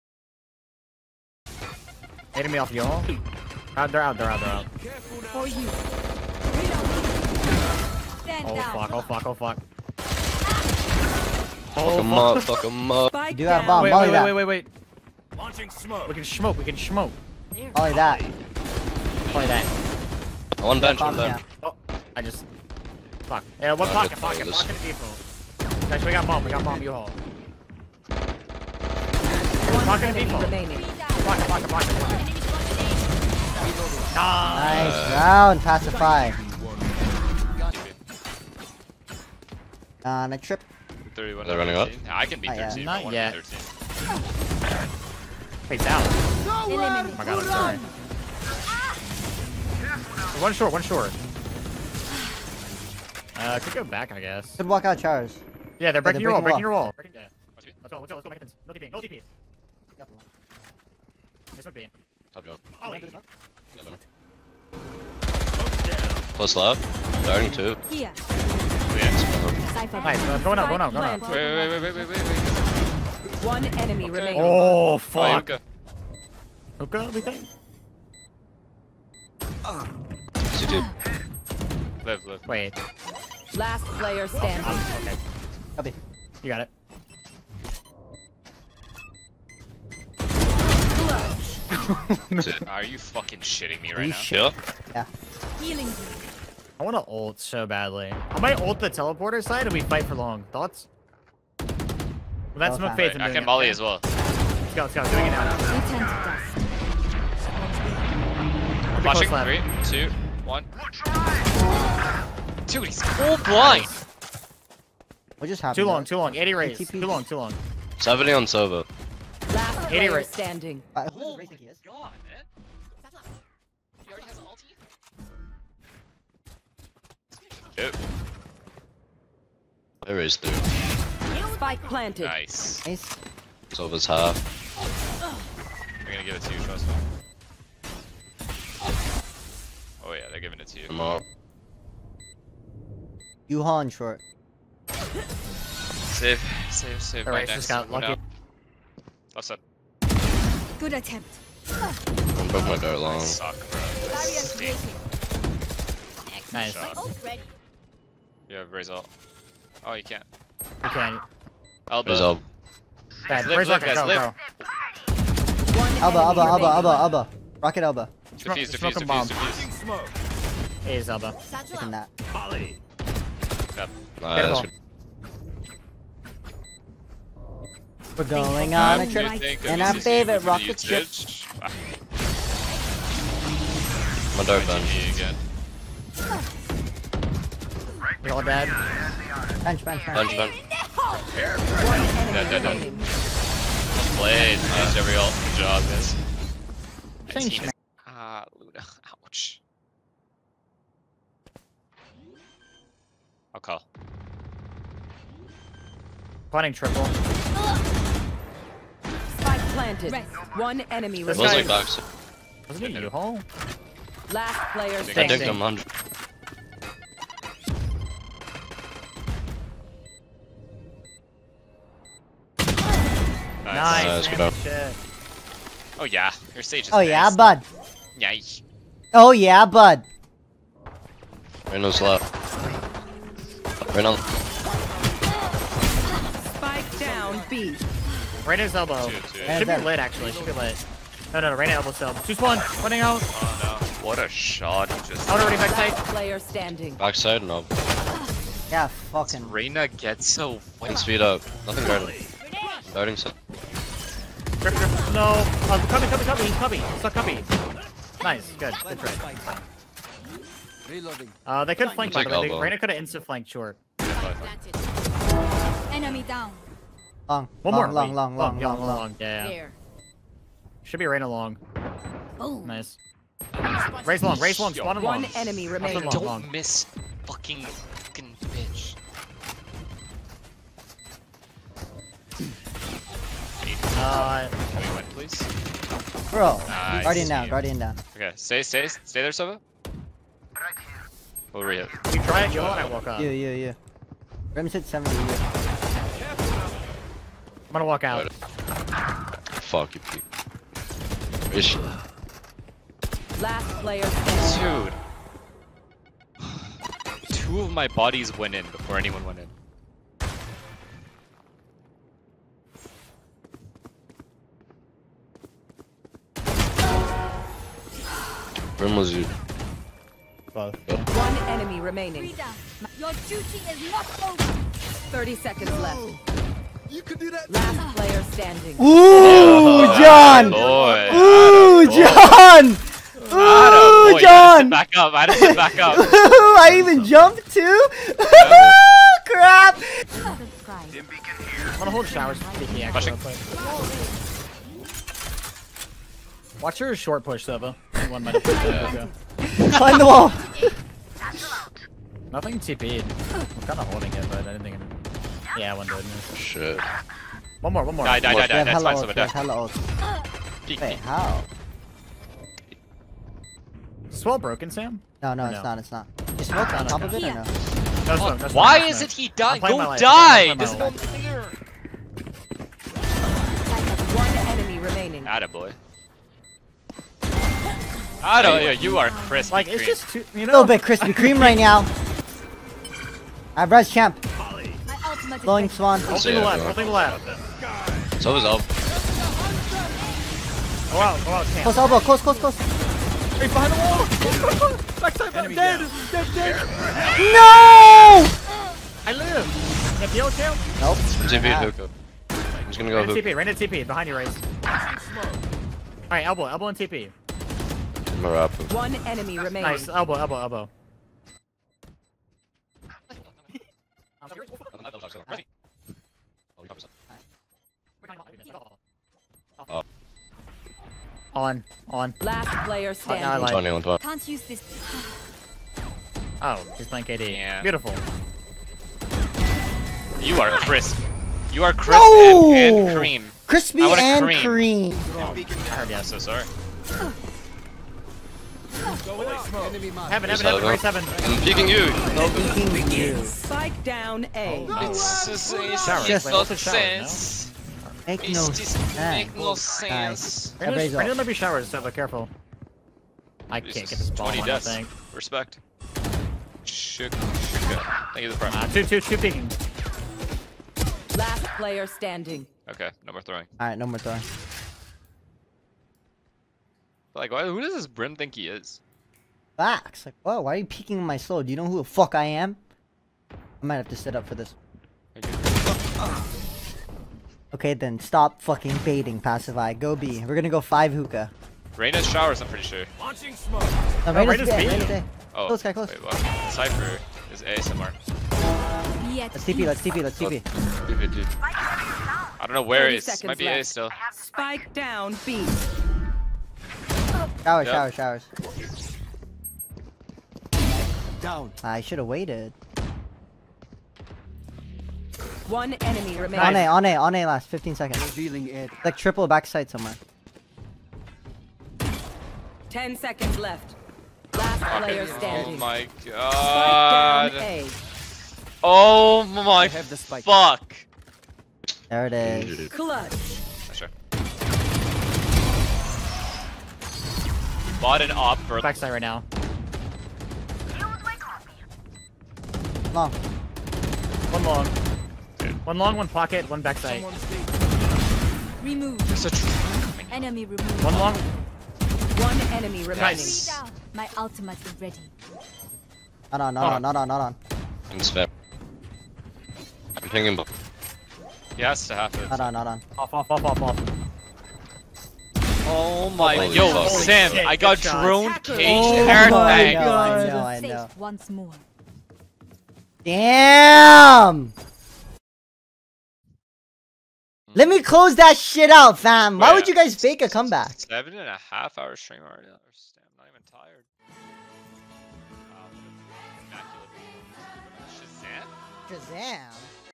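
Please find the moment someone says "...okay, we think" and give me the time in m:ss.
1:16.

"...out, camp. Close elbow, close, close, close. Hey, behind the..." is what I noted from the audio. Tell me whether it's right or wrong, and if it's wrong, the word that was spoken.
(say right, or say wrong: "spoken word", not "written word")
right.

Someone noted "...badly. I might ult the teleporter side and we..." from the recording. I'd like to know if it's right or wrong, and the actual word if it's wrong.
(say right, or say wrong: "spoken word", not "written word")
right.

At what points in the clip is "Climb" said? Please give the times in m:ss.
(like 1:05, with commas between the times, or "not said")
5:49.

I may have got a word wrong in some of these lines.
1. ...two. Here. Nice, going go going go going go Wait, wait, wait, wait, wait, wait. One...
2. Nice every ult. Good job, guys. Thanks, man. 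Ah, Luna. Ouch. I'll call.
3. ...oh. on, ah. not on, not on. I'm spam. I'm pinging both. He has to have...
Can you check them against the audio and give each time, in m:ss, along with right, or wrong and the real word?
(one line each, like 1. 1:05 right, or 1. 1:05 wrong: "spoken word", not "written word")
1. 1:07 right
2. 3:14 right
3. 9:06 right.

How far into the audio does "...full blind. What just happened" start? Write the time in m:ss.
1:53.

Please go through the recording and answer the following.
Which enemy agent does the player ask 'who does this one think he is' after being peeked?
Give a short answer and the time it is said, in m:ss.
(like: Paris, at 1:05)
Brim, at 7:47.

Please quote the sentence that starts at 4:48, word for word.
Okay, stay, stay, stay there, Sova.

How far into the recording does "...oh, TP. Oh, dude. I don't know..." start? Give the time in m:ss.
8:10.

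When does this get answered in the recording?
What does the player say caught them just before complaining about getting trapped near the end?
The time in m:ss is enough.
9:17.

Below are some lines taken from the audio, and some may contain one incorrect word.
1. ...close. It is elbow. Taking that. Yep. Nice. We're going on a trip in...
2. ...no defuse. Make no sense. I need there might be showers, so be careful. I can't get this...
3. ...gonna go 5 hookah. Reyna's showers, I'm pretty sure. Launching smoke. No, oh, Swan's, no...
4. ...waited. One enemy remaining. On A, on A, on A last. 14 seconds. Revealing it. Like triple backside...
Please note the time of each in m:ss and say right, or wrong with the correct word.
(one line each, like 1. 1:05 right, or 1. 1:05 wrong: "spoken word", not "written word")
1. 2:49 wrong: "defuse", not "close"
2. 7:28 wrong: "sense", not "defuse"
3. 8:00 wrong: "Reyna", not "Swan"
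4. 8:22 wrong: "15", not "14".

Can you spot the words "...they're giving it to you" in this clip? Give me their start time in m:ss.
2:20.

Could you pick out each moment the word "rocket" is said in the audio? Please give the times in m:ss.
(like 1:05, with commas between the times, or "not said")
2:47, 3:00.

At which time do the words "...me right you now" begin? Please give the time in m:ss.
1:33.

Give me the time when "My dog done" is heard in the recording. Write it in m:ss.
3:04.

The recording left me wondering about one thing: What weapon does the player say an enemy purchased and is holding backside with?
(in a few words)
an op.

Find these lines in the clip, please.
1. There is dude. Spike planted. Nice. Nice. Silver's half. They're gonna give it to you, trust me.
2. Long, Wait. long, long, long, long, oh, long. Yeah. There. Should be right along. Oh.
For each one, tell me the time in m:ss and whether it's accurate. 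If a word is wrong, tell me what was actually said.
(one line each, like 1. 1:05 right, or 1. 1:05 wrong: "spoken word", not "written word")
1. 2:10 right
2. 4:27 right.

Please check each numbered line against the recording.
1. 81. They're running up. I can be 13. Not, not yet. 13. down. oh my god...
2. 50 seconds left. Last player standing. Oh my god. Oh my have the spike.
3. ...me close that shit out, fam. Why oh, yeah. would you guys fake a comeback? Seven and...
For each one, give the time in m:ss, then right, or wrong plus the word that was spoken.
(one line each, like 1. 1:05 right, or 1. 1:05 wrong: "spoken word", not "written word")
1. 0:41 wrong: "31", not "81"
2. 8:32 wrong: "10", not "50"
3. 9:27 right.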